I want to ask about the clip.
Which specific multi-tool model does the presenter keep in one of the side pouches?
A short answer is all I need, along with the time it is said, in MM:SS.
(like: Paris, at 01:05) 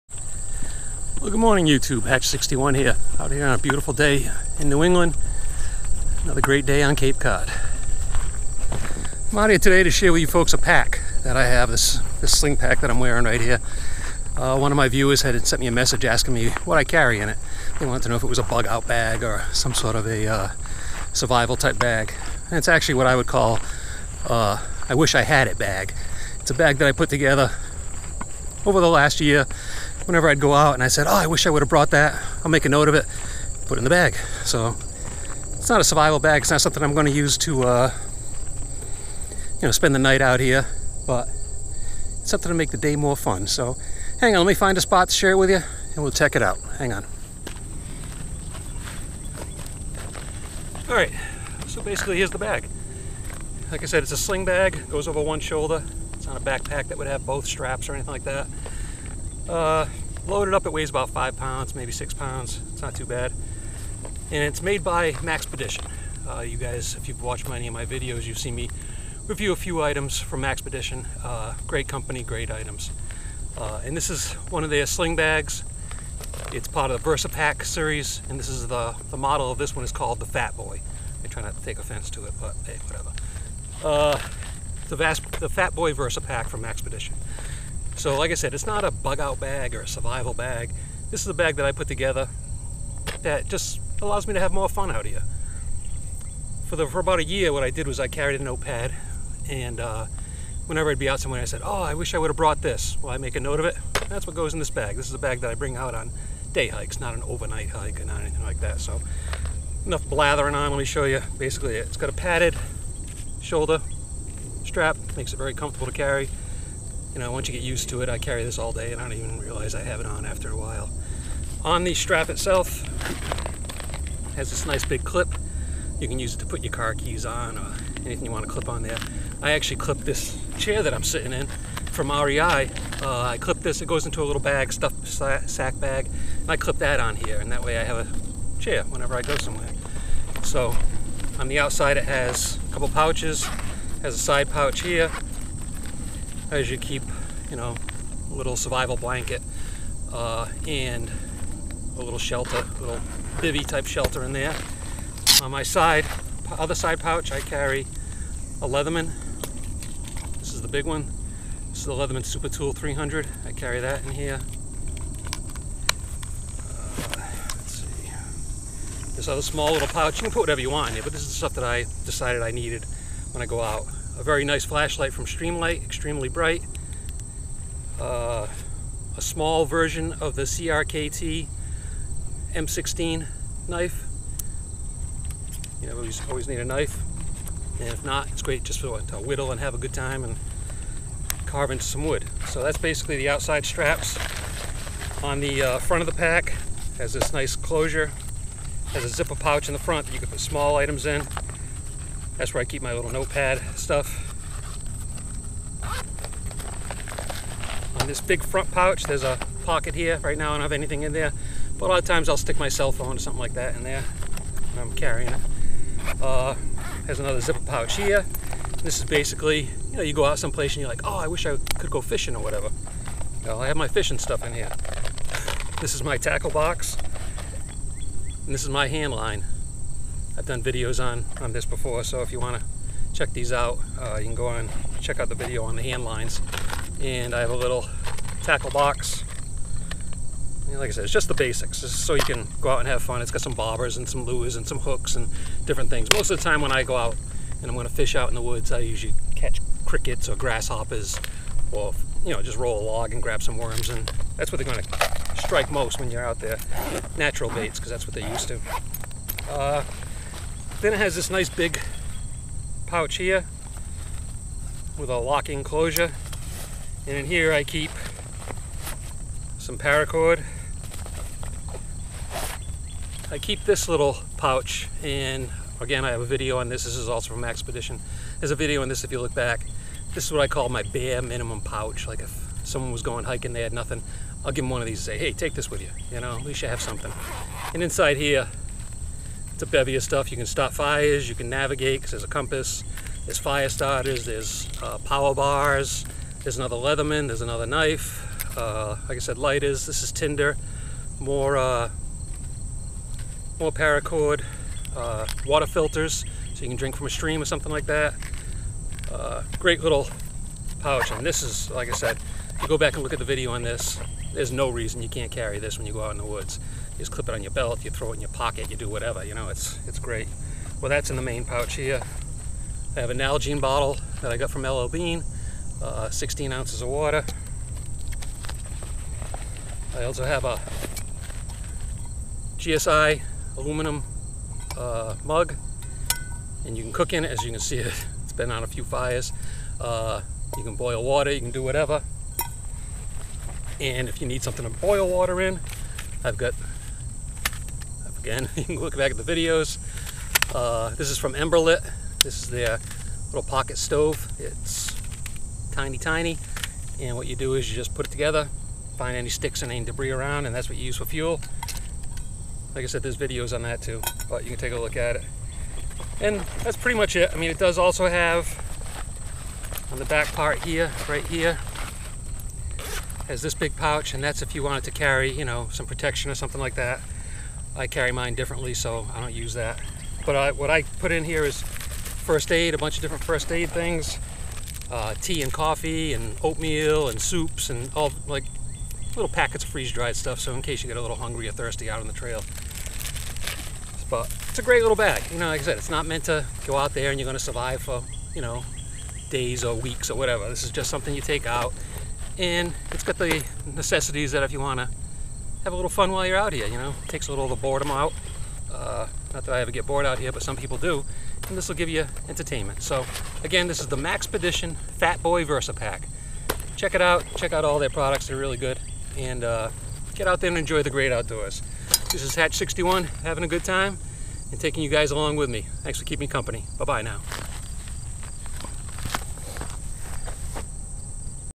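Leatherman Super Tool 300, at 02:41.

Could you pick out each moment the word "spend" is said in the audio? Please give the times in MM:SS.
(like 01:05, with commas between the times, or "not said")
00:39.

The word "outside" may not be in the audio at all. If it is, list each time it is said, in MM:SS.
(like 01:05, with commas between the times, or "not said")
02:21, 03:13.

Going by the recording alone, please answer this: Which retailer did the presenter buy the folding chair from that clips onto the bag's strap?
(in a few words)
REI.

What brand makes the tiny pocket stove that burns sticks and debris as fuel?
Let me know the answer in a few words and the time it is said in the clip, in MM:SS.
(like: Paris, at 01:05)
Emberlit, at 05:51.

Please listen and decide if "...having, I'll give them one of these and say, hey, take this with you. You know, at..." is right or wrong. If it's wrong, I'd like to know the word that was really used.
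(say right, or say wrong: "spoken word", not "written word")
wrong: "nothing", not "having".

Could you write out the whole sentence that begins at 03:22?
That's where I keep my little notepad stuff.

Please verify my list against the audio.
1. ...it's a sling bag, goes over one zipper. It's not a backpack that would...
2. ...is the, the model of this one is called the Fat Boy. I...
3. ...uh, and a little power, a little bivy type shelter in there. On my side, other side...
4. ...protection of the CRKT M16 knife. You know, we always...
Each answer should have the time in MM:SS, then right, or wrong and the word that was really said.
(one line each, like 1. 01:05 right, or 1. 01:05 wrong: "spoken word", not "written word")
1. 00:54 wrong: "shoulder", not "zipper"
2. 01:18 right
3. 02:30 wrong: "shelter", not "power"
4. 02:59 wrong: "version", not "protection".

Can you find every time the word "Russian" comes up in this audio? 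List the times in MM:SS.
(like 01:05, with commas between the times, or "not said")
not said.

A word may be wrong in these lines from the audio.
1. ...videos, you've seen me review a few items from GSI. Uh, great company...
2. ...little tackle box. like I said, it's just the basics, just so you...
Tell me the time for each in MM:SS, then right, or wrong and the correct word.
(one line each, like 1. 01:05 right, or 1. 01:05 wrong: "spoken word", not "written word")
1. 01:07 wrong: "Maxpedition", not "GSI"
2. 03:57 right.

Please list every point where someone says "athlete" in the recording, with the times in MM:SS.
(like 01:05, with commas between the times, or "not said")
not said.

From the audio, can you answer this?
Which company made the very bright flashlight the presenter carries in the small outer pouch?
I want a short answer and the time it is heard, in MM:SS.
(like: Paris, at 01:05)
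Streamlight, at 02:55.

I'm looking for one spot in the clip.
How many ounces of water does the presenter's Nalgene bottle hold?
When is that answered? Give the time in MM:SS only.
05:26.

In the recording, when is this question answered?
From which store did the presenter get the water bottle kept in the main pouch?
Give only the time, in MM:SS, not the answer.
05:24.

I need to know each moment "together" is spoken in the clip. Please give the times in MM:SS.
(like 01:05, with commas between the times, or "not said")
00:27, 01:31, 05:58.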